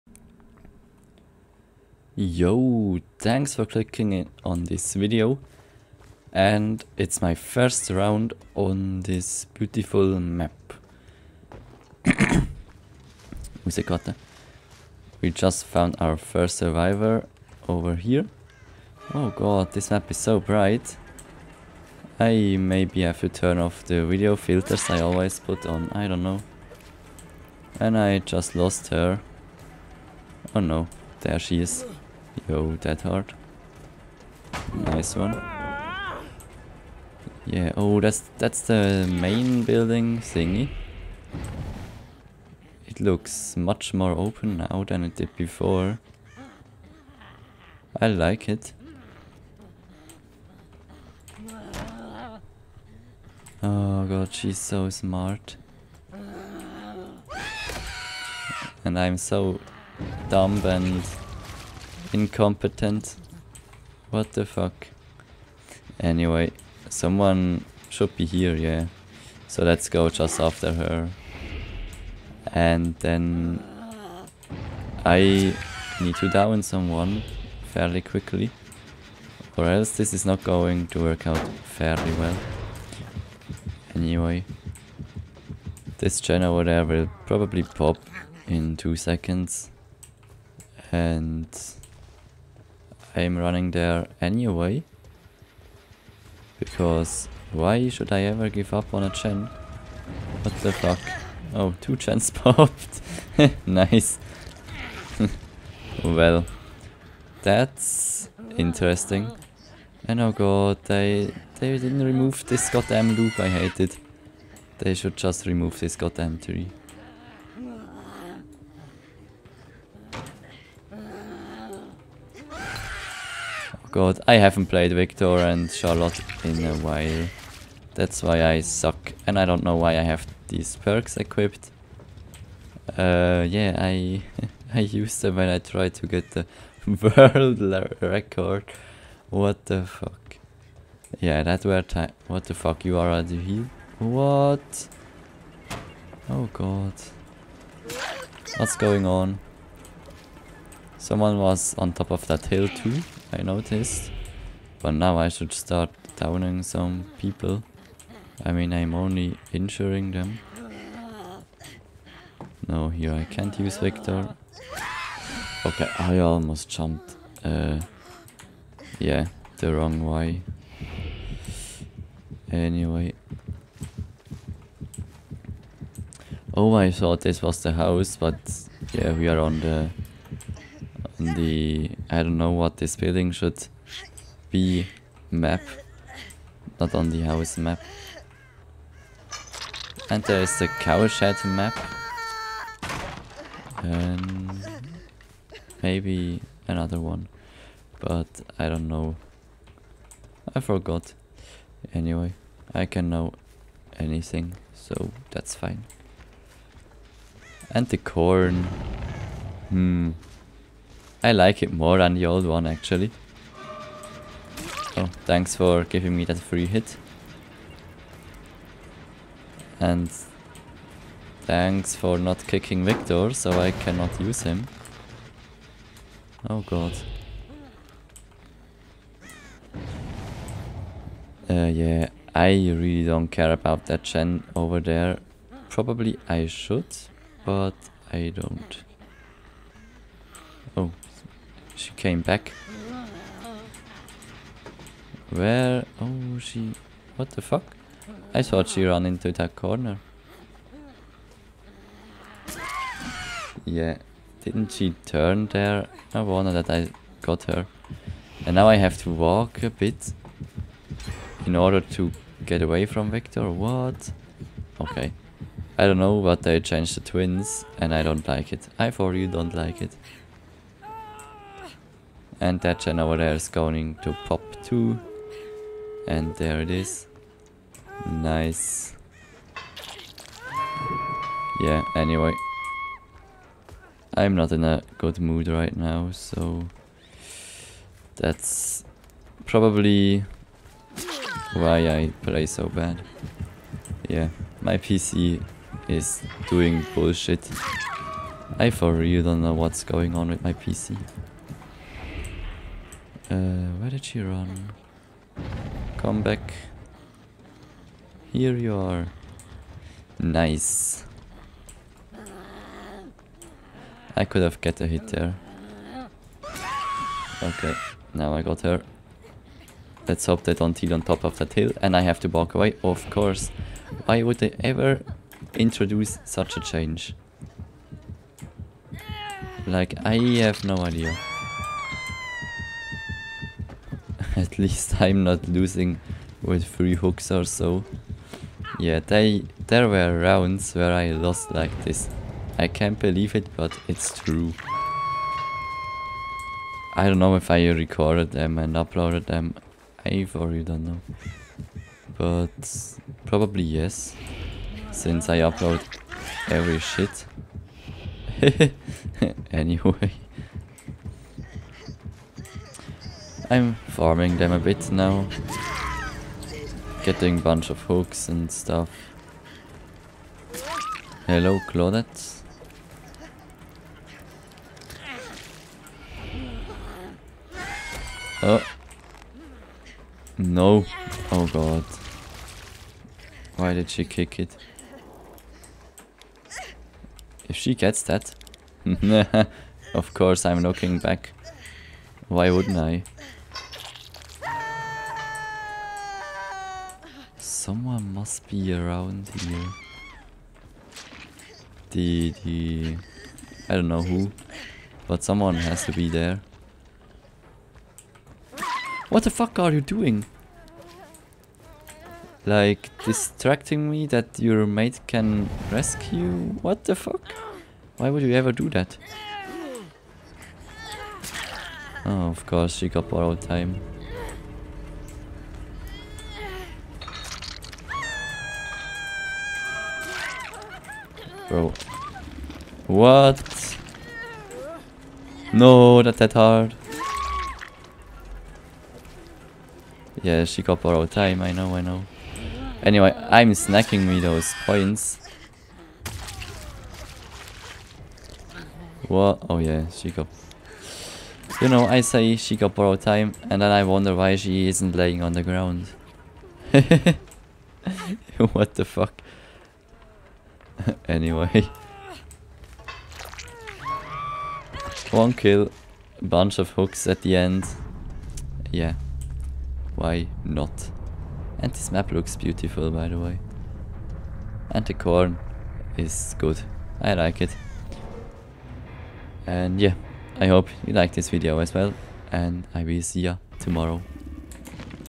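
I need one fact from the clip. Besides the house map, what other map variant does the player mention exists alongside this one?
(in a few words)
cow shed map.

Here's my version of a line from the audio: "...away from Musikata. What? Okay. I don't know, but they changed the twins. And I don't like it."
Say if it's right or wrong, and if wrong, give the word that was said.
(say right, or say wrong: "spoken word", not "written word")
wrong: "Victor", not "Musikata".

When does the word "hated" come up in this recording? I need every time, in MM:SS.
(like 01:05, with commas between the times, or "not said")
01:53.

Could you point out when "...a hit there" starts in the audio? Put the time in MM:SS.
05:14.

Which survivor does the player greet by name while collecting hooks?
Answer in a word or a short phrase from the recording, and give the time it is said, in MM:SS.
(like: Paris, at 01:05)
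Claudette, at 06:11.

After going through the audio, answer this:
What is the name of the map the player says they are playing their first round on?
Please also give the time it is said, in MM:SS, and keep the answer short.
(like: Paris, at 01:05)
Musikata, at 00:13.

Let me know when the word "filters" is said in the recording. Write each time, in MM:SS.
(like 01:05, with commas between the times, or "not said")
00:24.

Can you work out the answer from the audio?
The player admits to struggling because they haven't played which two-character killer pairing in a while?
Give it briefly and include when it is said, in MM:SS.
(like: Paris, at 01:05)
Victor and Charlotte, at 02:04.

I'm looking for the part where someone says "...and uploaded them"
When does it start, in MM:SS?
05:48.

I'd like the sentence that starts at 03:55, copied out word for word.
Probably I should, but I don't.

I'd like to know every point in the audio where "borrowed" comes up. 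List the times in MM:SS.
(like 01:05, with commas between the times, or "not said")
07:03, 07:20, 07:32.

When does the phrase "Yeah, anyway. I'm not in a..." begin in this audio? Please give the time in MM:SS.
04:41.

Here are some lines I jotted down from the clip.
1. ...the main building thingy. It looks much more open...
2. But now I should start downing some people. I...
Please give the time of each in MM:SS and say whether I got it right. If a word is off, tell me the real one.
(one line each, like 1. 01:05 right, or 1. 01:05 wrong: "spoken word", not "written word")
1. 00:38 right
2. 02:34 right.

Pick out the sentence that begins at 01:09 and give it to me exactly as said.
So let's go just after her.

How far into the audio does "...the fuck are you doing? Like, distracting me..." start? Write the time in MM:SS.
06:49.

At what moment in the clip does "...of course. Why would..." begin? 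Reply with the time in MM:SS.
05:22.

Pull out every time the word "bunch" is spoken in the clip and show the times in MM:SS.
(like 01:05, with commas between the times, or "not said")
06:07, 07:46.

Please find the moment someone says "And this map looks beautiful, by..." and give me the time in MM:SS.
07:51.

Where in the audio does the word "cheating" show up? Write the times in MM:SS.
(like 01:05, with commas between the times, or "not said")
not said.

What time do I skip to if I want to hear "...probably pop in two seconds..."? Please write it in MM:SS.
01:27.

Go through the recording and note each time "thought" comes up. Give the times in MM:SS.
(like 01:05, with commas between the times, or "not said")
02:56, 04:08.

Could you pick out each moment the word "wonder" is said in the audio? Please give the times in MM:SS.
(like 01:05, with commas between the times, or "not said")
04:16, 07:33.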